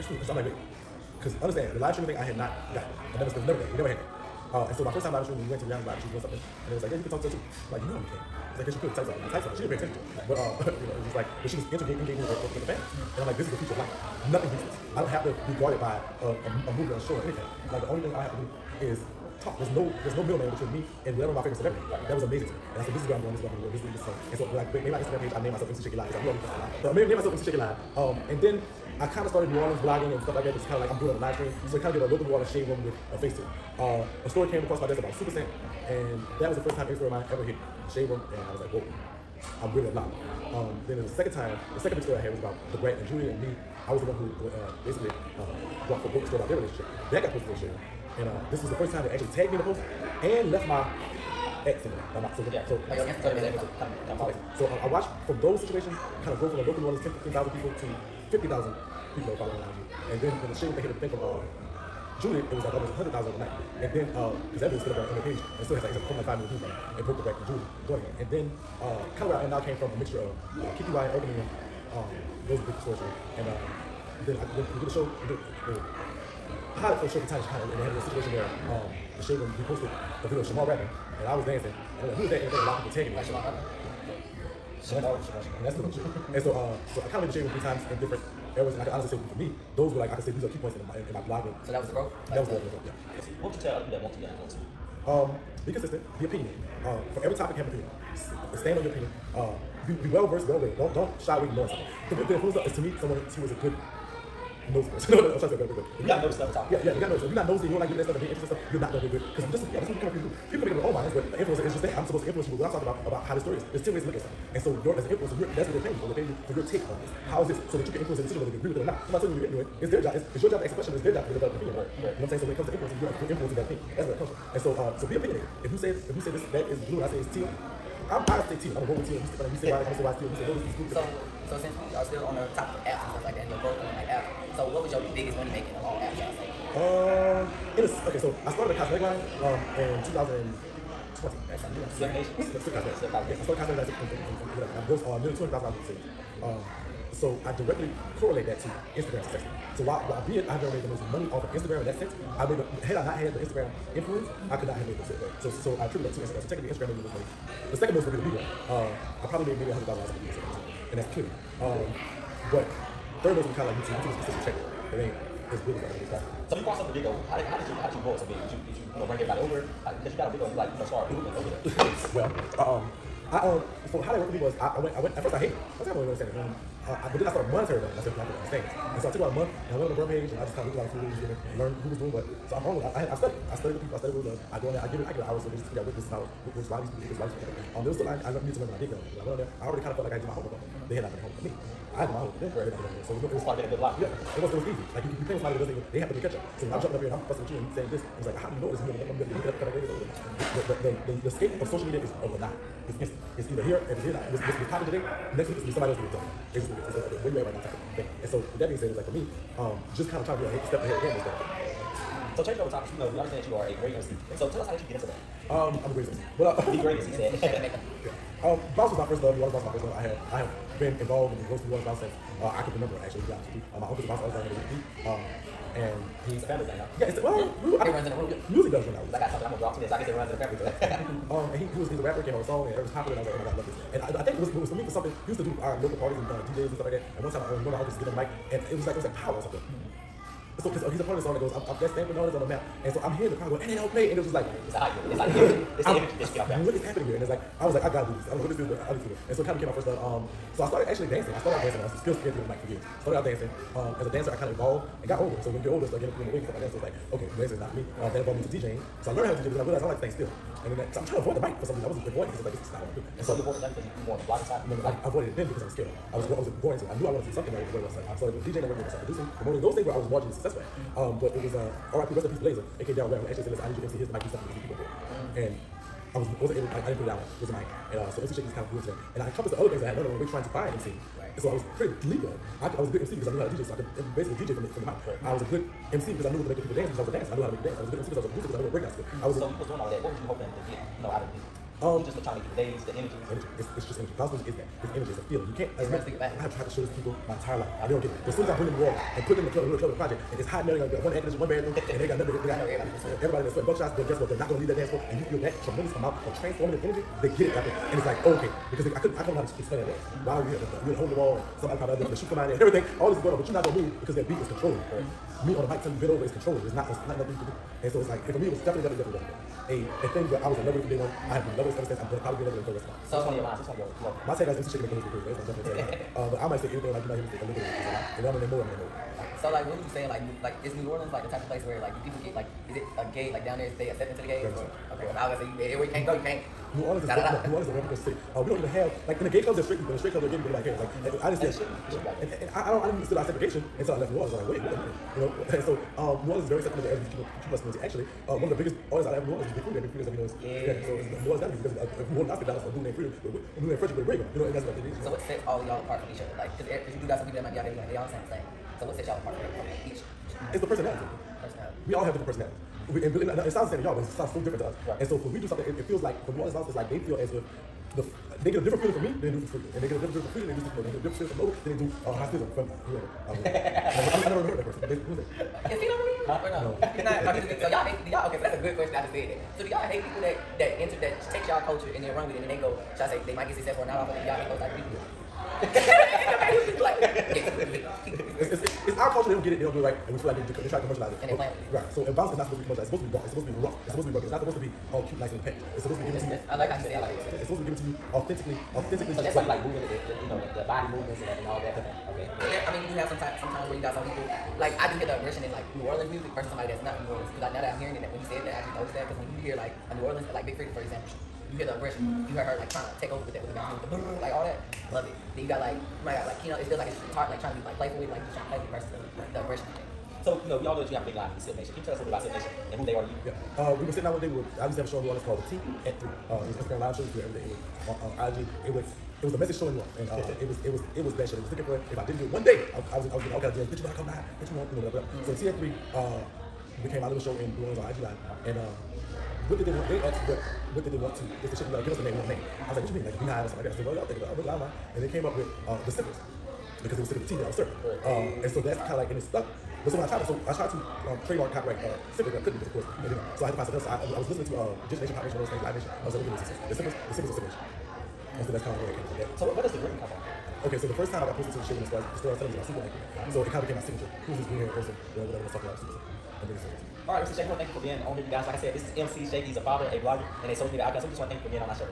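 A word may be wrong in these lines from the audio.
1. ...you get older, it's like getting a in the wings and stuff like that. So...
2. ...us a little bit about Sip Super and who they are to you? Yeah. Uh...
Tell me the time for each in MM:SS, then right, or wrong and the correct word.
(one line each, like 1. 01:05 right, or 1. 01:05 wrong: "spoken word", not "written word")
1. 04:15 right
2. 07:01 wrong: "Nation", not "Super".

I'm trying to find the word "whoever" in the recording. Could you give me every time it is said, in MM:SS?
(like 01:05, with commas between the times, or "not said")
06:12.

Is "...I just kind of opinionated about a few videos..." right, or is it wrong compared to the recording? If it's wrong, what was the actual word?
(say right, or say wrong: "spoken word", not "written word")
wrong: "looked", not "opinionated".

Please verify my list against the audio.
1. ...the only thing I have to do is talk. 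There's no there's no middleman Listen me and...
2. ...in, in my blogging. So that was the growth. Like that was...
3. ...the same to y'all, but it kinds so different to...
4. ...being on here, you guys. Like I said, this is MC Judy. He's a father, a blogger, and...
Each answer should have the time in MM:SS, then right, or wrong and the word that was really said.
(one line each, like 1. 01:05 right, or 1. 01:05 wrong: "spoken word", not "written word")
1. 00:17 wrong: "between", not "Listen"
2. 01:30 right
3. 06:03 wrong: "sounds", not "kinds"
4. 07:47 wrong: "Shake", not "Judy".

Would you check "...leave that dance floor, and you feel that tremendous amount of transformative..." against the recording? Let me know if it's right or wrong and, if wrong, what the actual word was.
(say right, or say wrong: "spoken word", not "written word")
right.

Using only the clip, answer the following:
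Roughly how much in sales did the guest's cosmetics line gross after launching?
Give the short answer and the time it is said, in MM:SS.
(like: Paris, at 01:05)
$200,000, at 02:25.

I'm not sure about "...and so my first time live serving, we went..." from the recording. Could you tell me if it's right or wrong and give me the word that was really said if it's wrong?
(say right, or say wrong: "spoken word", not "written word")
wrong: "streaming", not "serving".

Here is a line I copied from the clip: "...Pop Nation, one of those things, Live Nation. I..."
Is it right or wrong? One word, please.
right.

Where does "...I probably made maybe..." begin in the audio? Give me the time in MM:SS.
02:39.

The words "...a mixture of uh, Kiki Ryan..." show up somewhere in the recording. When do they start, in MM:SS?
01:09.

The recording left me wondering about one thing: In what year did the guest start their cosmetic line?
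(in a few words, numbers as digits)
2020.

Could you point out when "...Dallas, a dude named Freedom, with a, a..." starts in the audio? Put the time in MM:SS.
05:52.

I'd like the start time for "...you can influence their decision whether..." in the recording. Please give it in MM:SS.
01:57.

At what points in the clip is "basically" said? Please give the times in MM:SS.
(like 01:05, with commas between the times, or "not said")
00:44, 04:44.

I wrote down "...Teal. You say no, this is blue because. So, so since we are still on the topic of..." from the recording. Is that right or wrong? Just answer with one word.
right.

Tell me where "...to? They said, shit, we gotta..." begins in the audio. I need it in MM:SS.
07:21.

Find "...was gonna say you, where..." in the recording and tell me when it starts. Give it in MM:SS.
05:35.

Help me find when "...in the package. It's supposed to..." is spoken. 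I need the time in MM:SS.
06:35.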